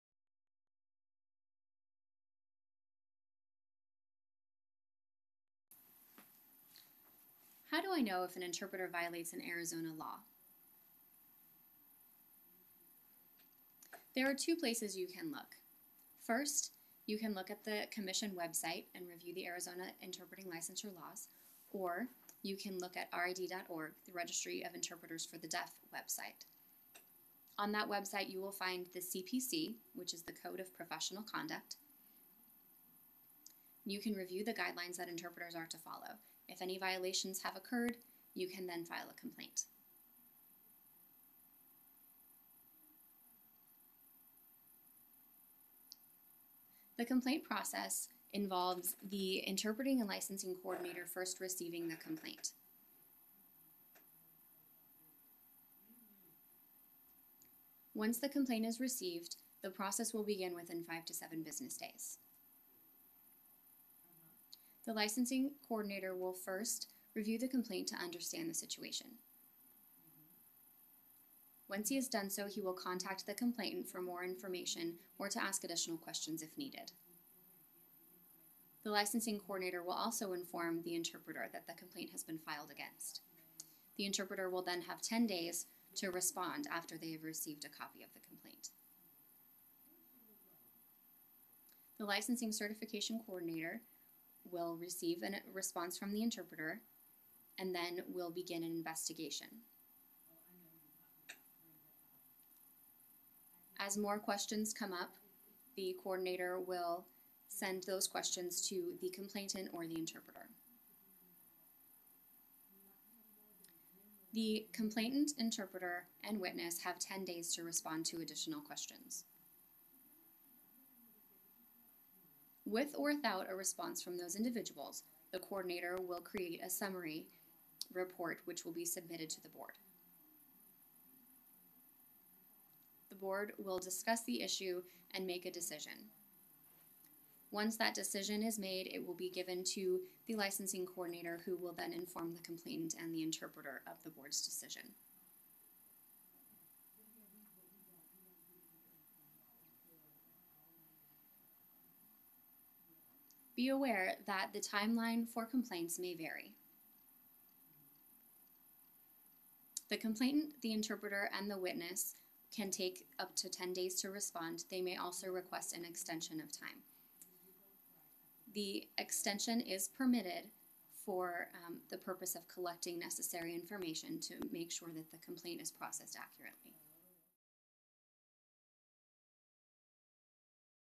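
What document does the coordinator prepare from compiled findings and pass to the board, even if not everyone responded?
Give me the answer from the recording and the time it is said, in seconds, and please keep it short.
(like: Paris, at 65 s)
summary report, at 126 s.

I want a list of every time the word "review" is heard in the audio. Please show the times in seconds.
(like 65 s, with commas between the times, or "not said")
19 s, 34 s, 67 s.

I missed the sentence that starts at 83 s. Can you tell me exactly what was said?
The interpreter will then have 10 days to respond after they have received a copy of the complaint.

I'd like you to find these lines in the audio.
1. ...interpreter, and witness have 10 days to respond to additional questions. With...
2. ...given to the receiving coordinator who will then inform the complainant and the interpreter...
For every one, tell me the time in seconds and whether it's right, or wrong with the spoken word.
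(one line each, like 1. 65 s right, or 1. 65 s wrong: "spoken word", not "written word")
1. 115 s right
2. 139 s wrong: "licensing", not "receiving".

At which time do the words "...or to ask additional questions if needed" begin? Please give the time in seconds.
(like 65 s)
75 s.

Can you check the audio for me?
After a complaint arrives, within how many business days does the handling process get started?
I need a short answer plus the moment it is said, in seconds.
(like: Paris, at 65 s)
5 to 7, at 60 s.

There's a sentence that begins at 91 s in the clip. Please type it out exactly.
The licensing certification coordinator will receive a response from the interpreter, and then we'll begin an investigation.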